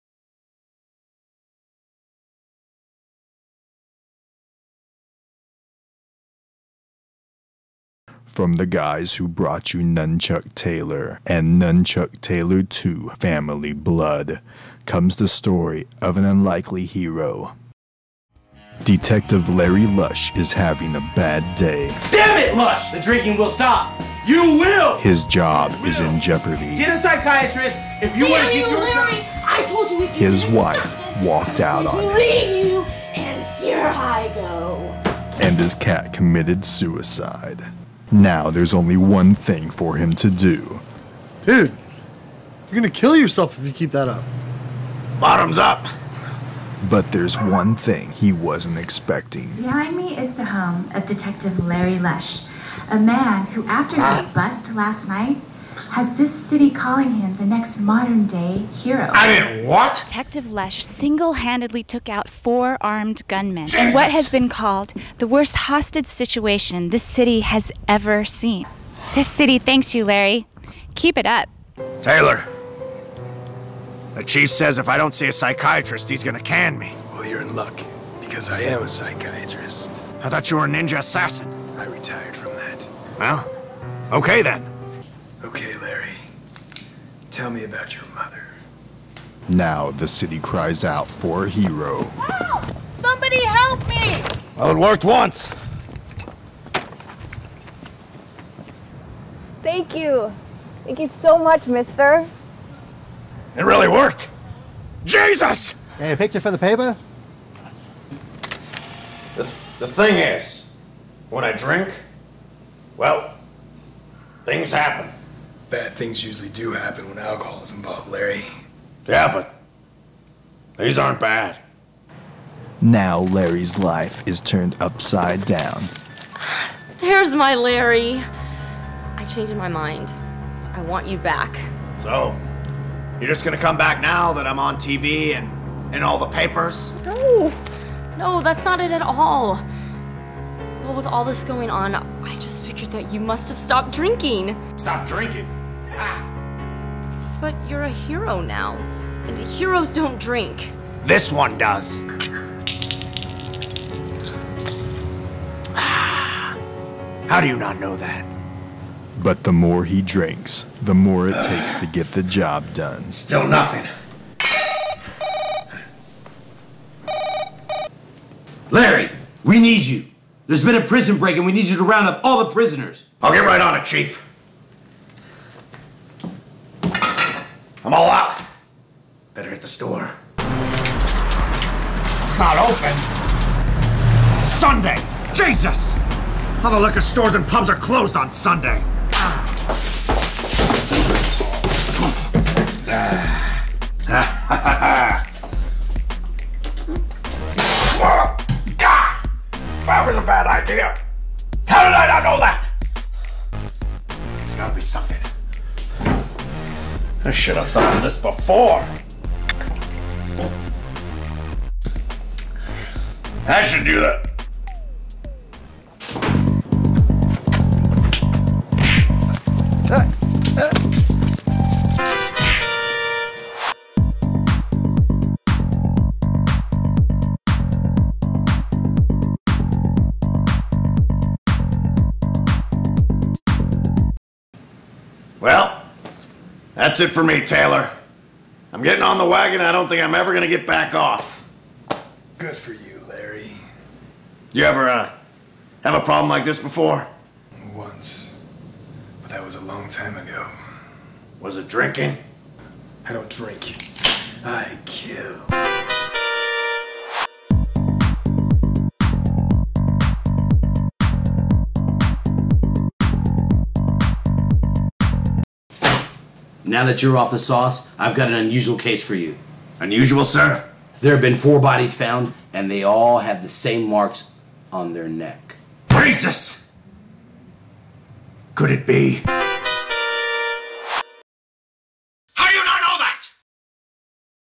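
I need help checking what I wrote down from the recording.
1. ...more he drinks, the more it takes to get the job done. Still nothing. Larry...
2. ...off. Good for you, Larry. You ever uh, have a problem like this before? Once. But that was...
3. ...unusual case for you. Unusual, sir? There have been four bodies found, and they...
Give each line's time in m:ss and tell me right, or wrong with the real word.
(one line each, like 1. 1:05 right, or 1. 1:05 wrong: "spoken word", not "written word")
1. 2:39 right
2. 4:00 right
3. 4:28 right.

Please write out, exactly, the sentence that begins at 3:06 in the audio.
All the liquor stores and pubs are closed on Sunday.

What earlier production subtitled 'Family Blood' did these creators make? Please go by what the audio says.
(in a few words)
Nun Chuck Taylor 2.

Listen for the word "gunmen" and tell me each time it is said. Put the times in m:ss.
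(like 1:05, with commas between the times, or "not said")
1:03.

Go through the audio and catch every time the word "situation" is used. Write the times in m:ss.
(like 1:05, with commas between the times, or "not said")
1:06.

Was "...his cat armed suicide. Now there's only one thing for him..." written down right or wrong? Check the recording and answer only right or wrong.
wrong.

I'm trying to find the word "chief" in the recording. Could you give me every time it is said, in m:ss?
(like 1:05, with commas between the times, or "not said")
1:14, 2:53.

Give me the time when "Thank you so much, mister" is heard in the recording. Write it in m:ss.
1:40.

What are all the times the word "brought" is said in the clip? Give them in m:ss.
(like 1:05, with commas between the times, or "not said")
0:09.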